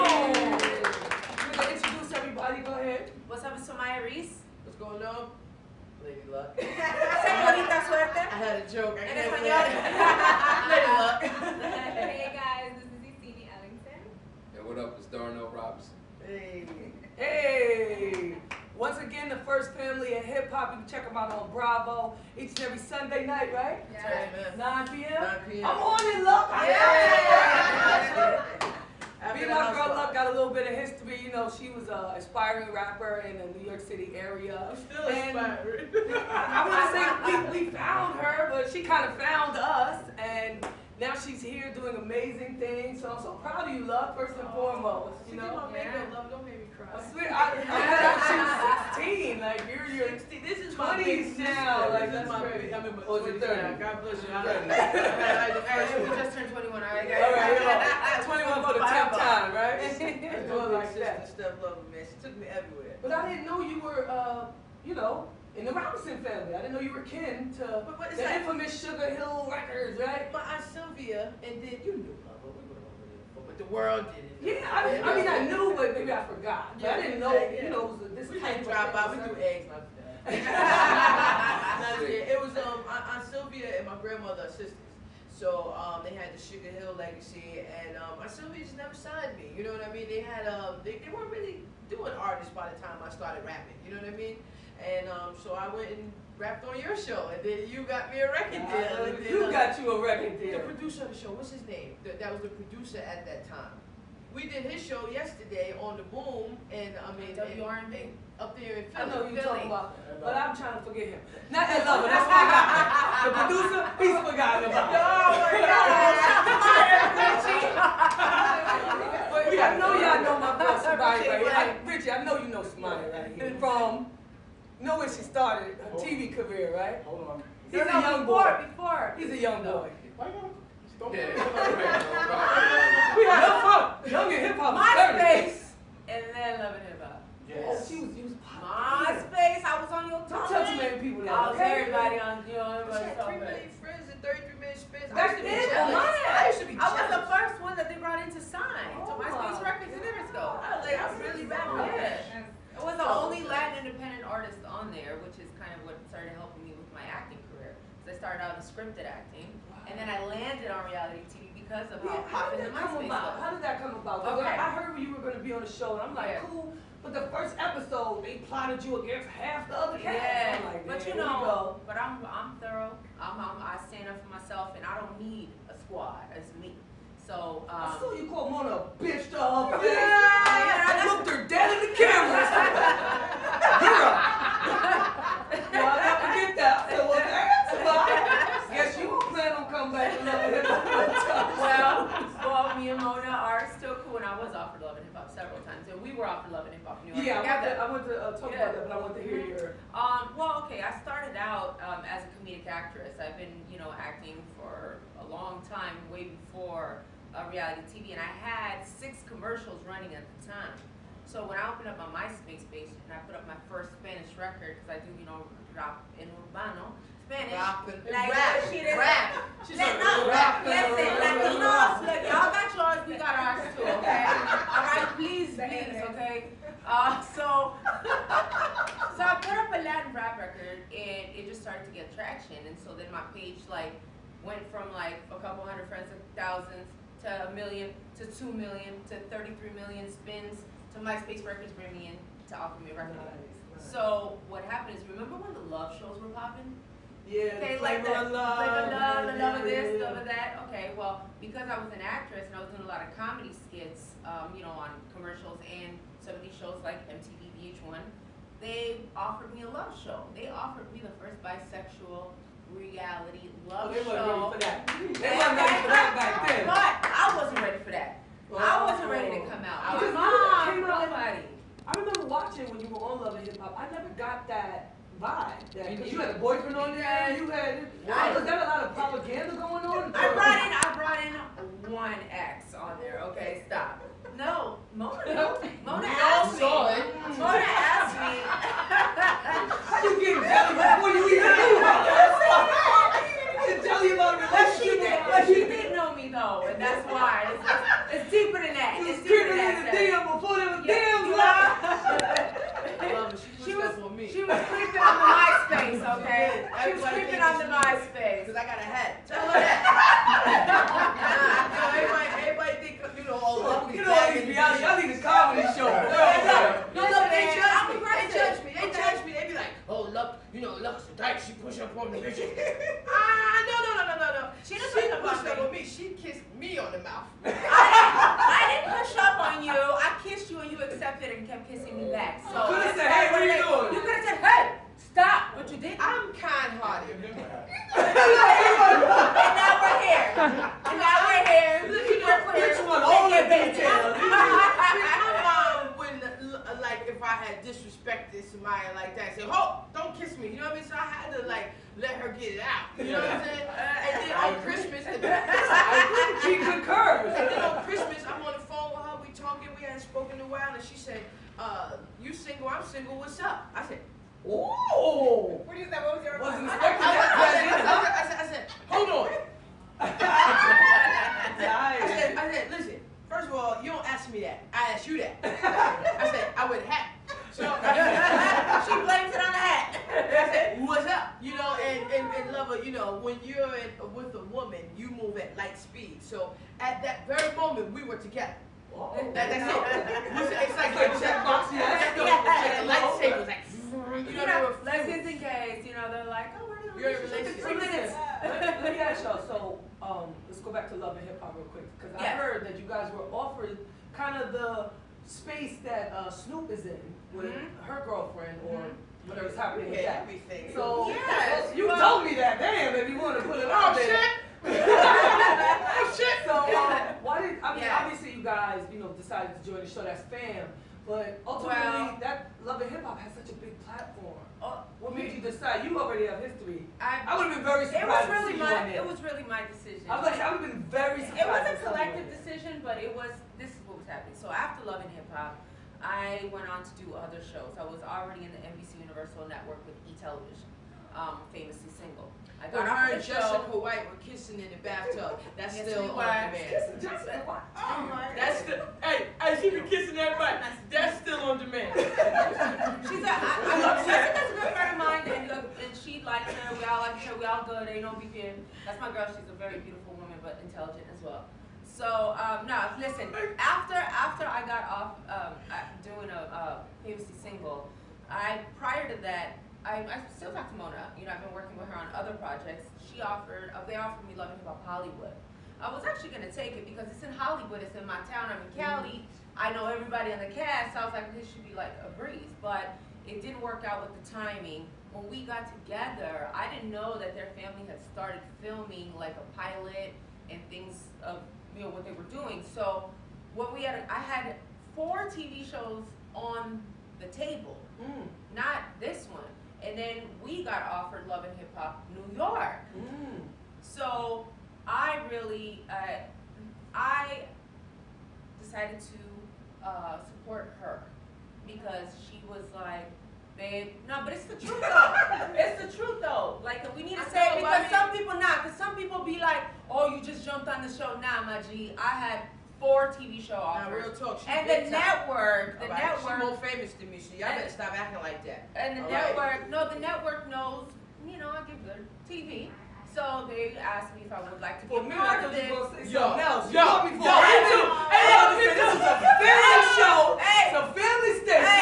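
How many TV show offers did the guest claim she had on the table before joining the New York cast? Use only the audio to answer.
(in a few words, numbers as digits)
4.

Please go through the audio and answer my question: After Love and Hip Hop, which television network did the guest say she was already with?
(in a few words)
E Television.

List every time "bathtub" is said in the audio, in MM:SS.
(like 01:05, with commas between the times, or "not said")
07:24.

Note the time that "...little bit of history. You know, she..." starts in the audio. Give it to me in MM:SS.
00:30.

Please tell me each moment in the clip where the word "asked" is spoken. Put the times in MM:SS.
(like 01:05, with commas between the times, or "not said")
06:14, 08:53.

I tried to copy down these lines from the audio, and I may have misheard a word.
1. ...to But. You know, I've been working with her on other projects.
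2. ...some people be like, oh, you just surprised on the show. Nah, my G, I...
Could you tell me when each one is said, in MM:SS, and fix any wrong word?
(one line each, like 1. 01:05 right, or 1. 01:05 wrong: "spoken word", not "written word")
1. 07:50 wrong: "Mona", not "But"
2. 08:38 wrong: "jumped", not "surprised".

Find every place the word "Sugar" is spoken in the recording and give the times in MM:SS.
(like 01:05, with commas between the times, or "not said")
01:08, 01:26.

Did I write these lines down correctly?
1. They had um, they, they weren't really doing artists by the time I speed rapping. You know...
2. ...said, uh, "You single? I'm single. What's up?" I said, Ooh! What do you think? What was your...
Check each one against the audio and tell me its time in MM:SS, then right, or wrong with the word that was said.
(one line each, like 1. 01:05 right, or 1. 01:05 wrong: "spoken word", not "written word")
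1. 01:30 wrong: "started", not "speed"
2. 06:00 right.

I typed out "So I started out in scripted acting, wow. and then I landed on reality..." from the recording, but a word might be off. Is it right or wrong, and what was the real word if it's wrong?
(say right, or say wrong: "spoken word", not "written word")
right.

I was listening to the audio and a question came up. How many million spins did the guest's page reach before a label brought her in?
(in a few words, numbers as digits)
33 million.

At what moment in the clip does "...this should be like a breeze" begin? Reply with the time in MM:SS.
08:01.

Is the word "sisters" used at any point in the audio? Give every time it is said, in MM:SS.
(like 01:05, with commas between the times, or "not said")
01:24.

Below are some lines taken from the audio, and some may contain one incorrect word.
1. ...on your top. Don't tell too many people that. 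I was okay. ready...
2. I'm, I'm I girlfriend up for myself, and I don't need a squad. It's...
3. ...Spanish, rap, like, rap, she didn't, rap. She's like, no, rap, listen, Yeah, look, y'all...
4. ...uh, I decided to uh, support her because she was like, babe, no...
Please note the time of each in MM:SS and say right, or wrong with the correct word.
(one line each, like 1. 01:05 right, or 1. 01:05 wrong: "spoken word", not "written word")
1. 02:19 wrong: "everybody", not "ready"
2. 02:53 wrong: "stand", not "girlfriend"
3. 03:37 wrong: "Latinos", not "Yeah"
4. 08:25 right.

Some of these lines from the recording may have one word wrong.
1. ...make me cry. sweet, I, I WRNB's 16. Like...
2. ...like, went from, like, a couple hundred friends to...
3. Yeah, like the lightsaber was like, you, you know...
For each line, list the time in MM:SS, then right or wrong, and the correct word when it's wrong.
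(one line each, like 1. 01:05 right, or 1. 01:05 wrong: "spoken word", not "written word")
1. 00:46 wrong: "She", not "WRNB"
2. 03:53 right
3. 06:31 right.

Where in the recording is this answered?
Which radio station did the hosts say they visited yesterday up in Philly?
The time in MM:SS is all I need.
01:47.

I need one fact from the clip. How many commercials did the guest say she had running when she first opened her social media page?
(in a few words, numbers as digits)
6.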